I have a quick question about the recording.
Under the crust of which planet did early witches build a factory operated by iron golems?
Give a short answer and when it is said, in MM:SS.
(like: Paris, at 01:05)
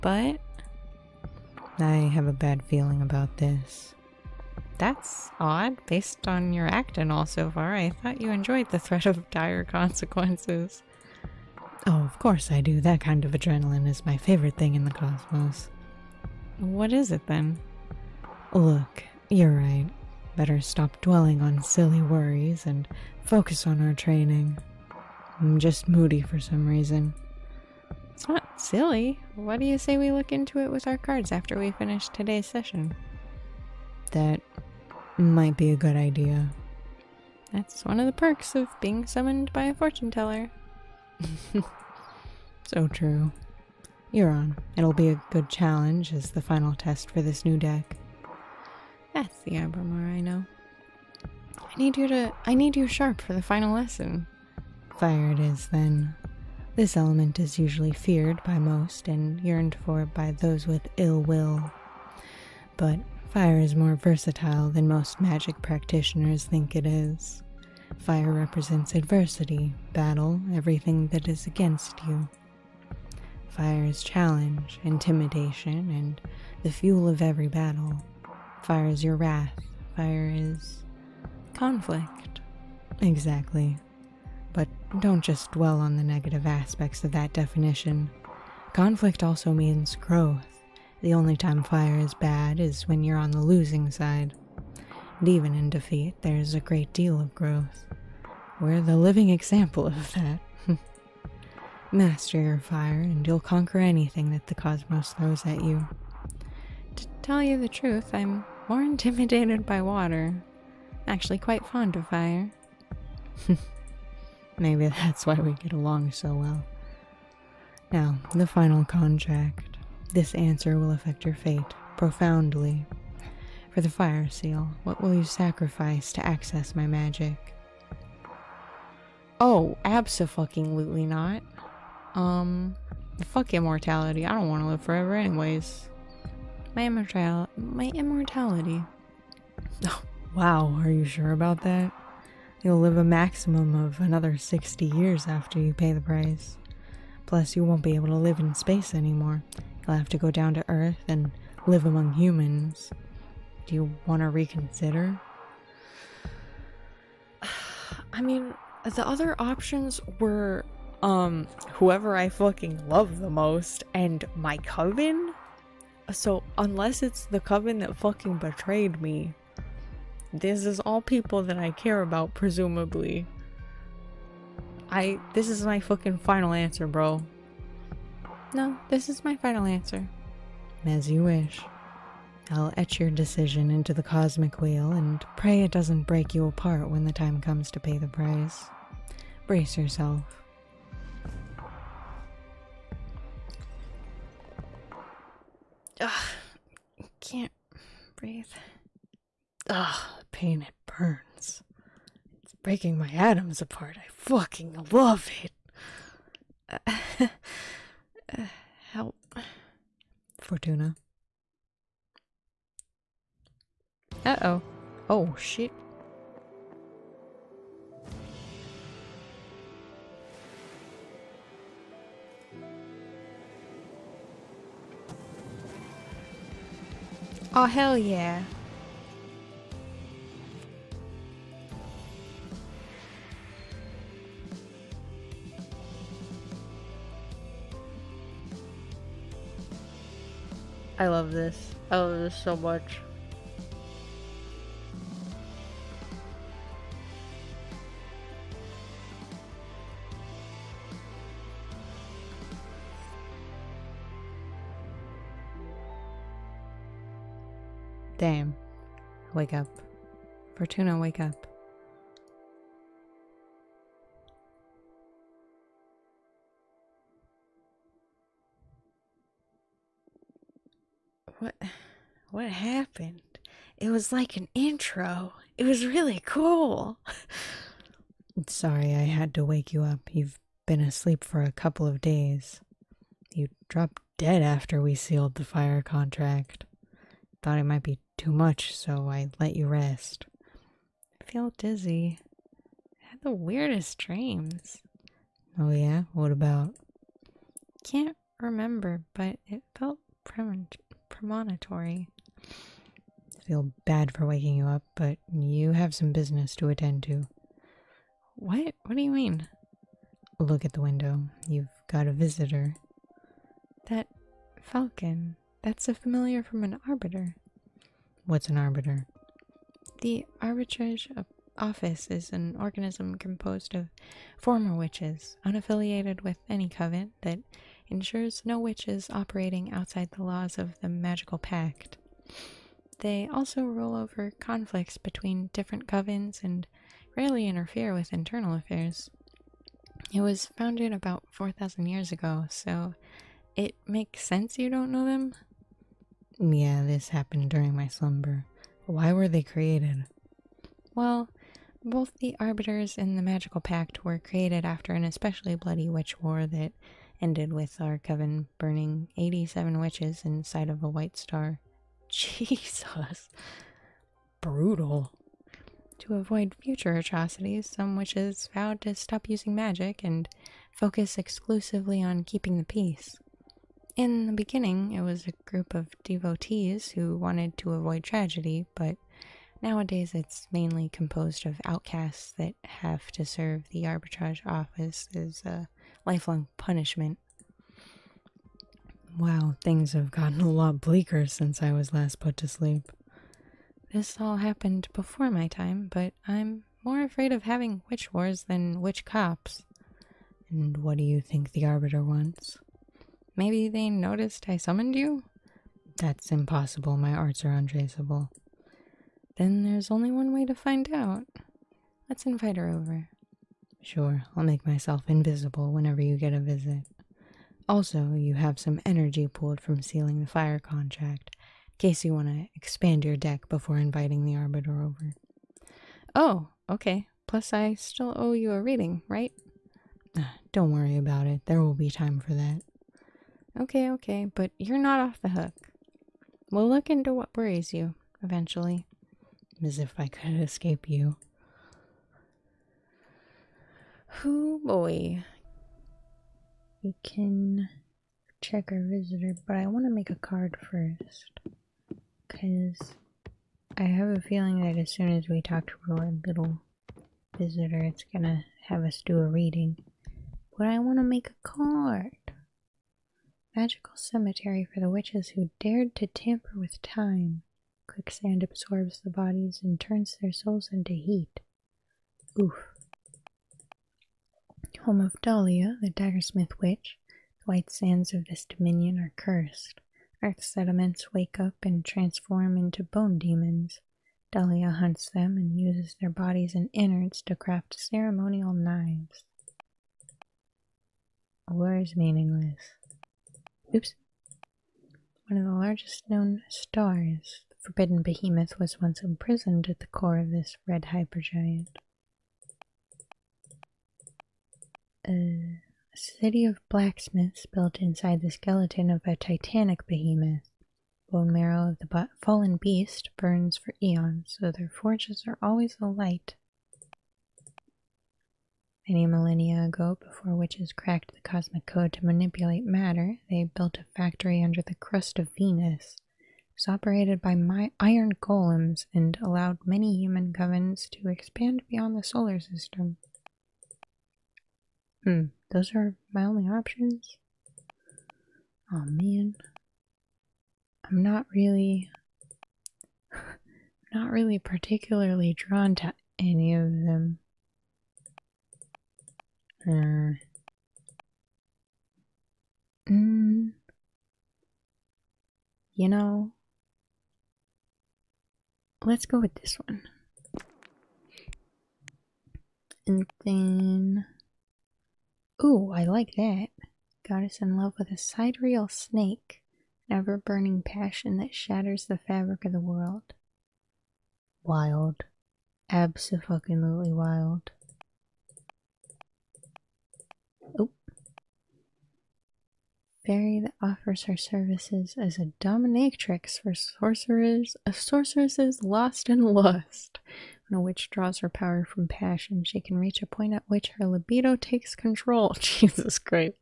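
Venus, at 08:45.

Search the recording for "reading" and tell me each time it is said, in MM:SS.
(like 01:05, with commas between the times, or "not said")
07:08, 07:39.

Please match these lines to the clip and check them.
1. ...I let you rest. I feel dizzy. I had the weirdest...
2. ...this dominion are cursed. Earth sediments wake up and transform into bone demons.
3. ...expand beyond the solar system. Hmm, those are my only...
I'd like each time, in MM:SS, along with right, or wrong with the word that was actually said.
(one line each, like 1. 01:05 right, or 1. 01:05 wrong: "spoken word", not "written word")
1. 04:49 right
2. 07:58 right
3. 08:51 right.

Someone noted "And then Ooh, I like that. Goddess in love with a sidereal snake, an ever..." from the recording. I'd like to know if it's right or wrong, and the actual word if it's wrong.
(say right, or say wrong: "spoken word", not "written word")
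right.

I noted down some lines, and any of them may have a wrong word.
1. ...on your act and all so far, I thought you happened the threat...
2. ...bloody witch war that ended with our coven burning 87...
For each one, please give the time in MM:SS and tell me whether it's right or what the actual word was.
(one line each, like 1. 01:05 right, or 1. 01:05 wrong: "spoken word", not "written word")
1. 00:06 wrong: "enjoyed", not "happened"
2. 05:55 right.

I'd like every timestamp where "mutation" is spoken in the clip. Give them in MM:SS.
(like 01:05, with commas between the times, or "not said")
not said.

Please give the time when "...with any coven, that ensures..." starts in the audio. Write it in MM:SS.
05:26.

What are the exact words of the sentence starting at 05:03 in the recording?
I feel bad for waking you up, but you have some business to attend to.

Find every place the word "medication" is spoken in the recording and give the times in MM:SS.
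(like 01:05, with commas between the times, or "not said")
not said.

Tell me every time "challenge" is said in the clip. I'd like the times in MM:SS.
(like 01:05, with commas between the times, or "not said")
00:45, 01:14.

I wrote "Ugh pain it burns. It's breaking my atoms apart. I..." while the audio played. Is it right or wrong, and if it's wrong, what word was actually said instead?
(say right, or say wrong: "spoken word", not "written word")
right.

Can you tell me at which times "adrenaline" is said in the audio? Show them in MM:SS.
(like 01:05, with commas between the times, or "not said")
00:13.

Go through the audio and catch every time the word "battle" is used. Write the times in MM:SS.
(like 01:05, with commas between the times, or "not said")
01:09, 01:17.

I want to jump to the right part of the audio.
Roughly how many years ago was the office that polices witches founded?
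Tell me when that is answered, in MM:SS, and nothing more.
05:41.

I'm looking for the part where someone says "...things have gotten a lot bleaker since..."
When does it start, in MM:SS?
06:29.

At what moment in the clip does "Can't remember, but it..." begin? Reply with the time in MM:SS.
04:57.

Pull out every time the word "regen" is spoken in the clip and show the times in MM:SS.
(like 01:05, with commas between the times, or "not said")
not said.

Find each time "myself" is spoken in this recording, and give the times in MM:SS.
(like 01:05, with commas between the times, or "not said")
06:54.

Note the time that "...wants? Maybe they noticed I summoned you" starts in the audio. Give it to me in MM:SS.
06:42.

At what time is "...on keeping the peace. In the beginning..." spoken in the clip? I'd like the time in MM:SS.
06:12.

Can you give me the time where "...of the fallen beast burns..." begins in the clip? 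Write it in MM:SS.
08:31.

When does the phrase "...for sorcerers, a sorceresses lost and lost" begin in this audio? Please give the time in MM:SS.
09:46.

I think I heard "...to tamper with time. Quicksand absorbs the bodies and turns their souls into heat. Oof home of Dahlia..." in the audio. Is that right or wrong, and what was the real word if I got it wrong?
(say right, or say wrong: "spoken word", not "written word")
right.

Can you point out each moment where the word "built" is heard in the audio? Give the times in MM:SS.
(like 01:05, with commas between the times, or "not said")
08:27, 08:43.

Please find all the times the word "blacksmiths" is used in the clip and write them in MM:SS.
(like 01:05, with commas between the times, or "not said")
08:26.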